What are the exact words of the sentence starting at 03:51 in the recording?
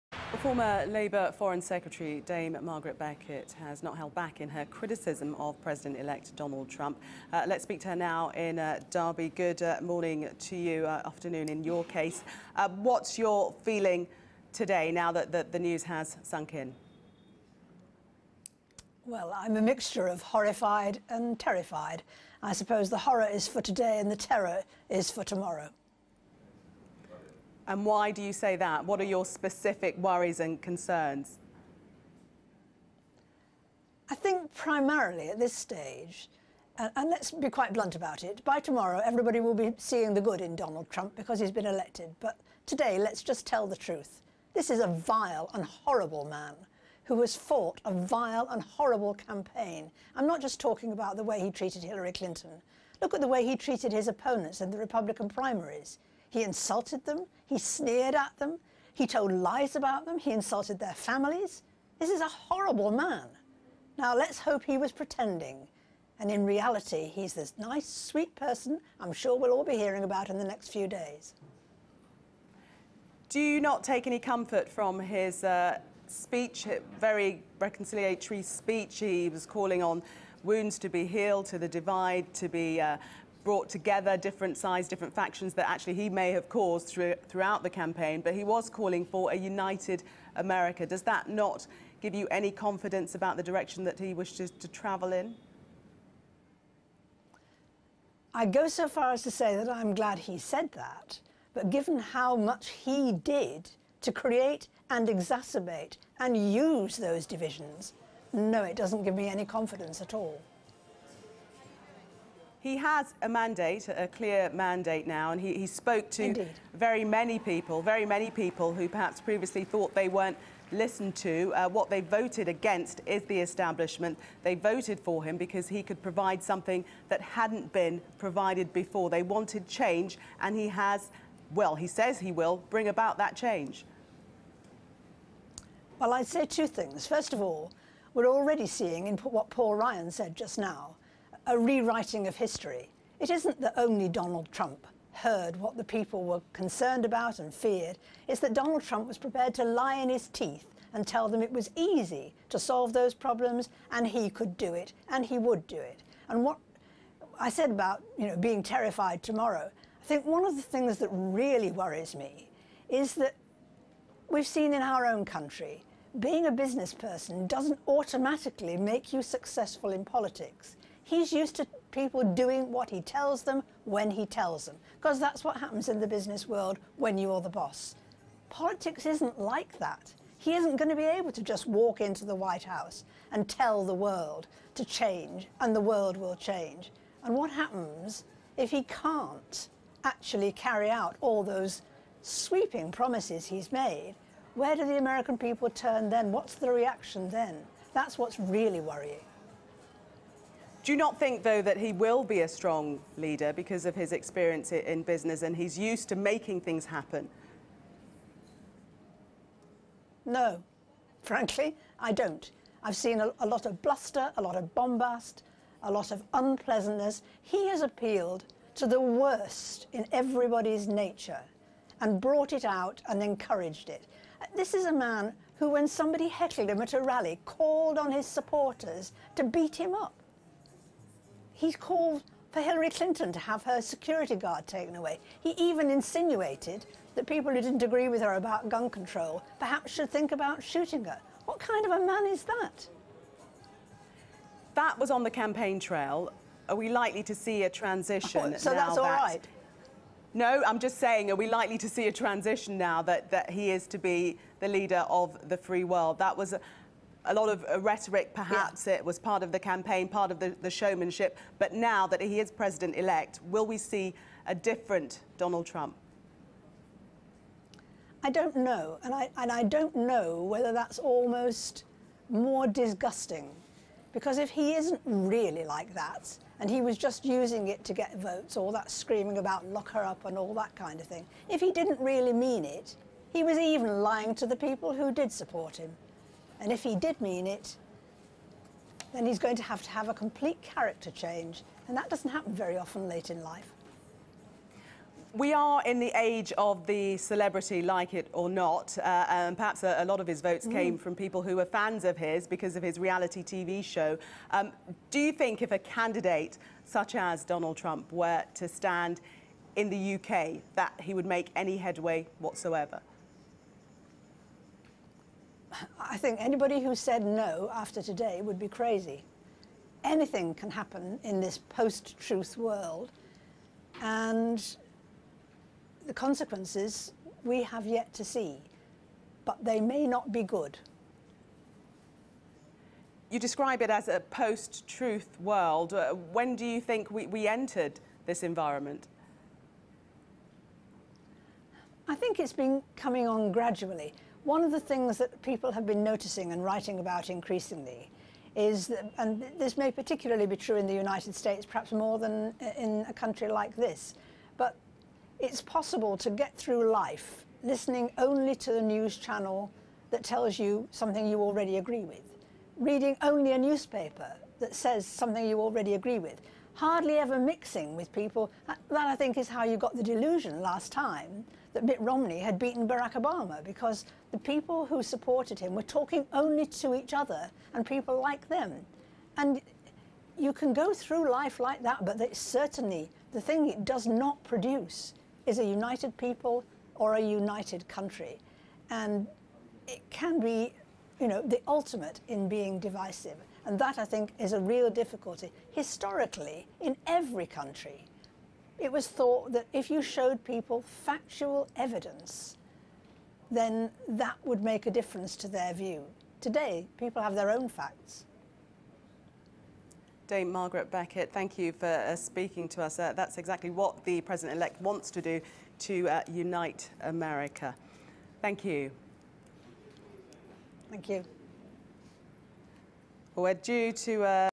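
He's called for Hillary Clinton to have her security guard taken away.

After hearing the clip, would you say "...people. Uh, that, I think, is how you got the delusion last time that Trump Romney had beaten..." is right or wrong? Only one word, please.
wrong.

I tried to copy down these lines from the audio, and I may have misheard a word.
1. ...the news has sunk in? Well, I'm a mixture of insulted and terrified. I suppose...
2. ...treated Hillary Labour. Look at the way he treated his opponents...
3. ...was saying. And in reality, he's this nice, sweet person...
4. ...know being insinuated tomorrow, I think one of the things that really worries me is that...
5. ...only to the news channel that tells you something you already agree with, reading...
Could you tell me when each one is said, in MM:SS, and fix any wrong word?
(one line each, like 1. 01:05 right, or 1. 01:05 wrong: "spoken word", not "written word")
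1. 00:15 wrong: "horrified", not "insulted"
2. 00:51 wrong: "Clinton", not "Labour"
3. 01:04 wrong: "pretending", not "saying"
4. 02:38 wrong: "terrified", not "insinuated"
5. 05:58 right.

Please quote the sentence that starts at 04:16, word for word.
That was a, a lot of uh, rhetoric, perhaps yeah.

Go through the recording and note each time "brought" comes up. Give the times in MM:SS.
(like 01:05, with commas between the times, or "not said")
01:23, 03:42.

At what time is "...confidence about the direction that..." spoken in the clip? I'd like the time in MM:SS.
01:32.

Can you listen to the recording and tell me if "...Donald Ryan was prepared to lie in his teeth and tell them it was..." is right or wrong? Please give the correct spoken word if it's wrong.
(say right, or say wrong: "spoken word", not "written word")
wrong: "Trump", not "Ryan".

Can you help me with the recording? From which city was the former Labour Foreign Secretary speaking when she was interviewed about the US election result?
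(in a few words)
Derby.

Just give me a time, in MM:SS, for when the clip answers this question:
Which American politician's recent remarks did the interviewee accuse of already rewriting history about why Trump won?
02:19.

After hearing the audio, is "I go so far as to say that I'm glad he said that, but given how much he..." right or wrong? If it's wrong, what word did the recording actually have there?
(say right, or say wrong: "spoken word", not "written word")
right.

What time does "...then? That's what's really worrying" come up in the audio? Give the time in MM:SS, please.
03:17.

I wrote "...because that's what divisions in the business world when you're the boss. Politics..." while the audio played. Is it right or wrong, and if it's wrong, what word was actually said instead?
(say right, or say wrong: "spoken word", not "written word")
wrong: "happens", not "divisions".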